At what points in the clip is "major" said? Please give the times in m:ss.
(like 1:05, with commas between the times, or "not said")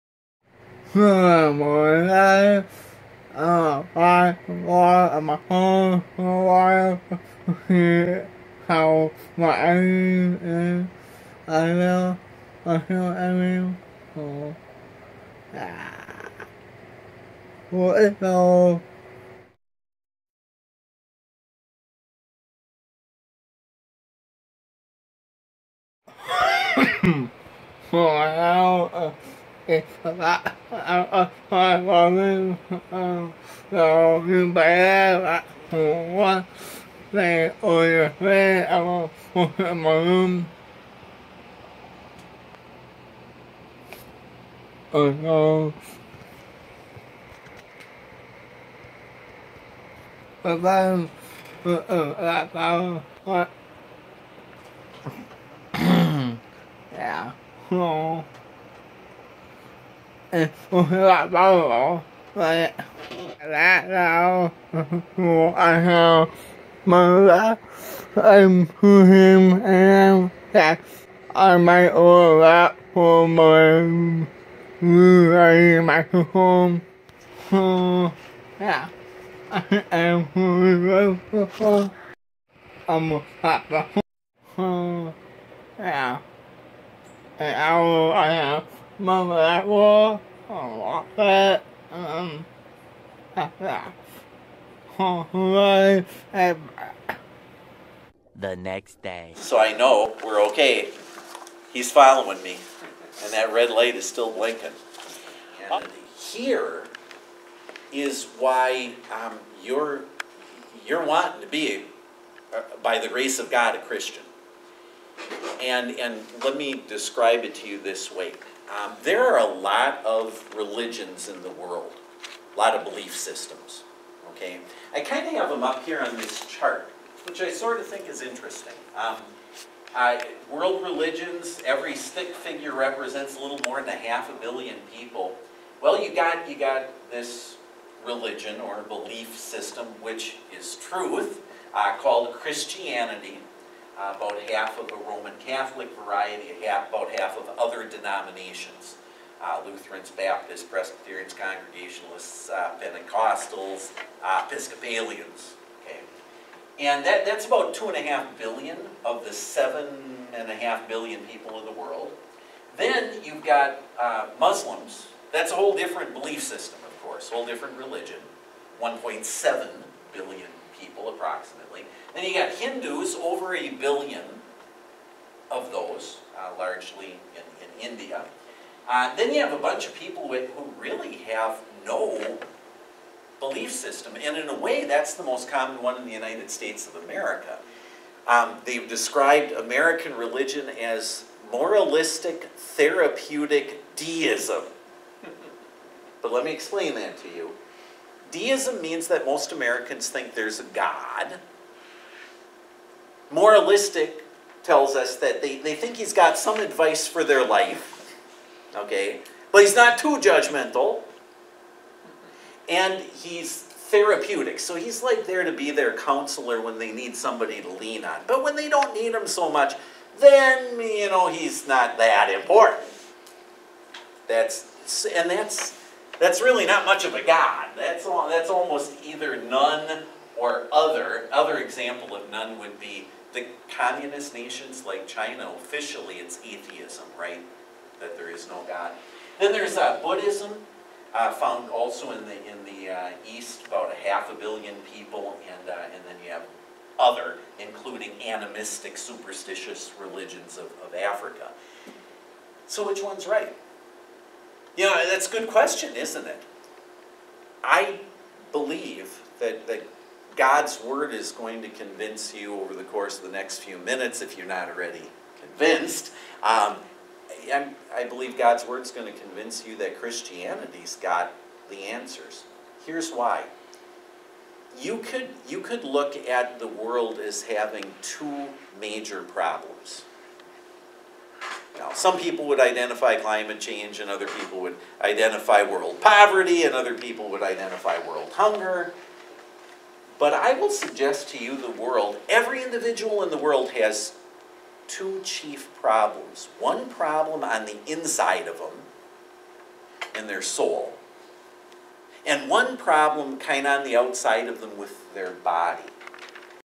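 4:38.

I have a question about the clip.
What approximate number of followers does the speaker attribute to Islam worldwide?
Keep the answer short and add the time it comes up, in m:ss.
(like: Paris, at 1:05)
1.7 billion, at 2:48.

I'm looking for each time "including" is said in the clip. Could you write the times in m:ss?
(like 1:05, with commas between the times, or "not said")
4:07.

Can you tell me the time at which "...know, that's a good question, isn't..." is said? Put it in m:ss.
4:14.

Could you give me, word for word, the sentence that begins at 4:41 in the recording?
Now, some people would identify climate change, and other people would identify world poverty, and other people would identify world hunger.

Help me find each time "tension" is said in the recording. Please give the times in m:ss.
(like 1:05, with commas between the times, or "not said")
not said.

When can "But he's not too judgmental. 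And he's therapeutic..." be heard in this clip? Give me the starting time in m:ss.
3:29.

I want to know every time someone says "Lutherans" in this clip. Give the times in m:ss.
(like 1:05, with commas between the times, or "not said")
2:29.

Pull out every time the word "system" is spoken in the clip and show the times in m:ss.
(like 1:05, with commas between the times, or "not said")
2:03, 2:19, 2:46, 3:03.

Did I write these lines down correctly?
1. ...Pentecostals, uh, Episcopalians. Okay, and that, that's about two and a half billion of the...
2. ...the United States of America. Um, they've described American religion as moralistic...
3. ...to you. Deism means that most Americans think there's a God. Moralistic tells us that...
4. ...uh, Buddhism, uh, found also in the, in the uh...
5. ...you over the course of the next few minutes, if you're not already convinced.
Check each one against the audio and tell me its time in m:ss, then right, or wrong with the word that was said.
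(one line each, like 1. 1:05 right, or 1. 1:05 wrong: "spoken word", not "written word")
1. 2:32 right
2. 3:06 right
3. 3:17 right
4. 3:59 right
5. 4:22 right.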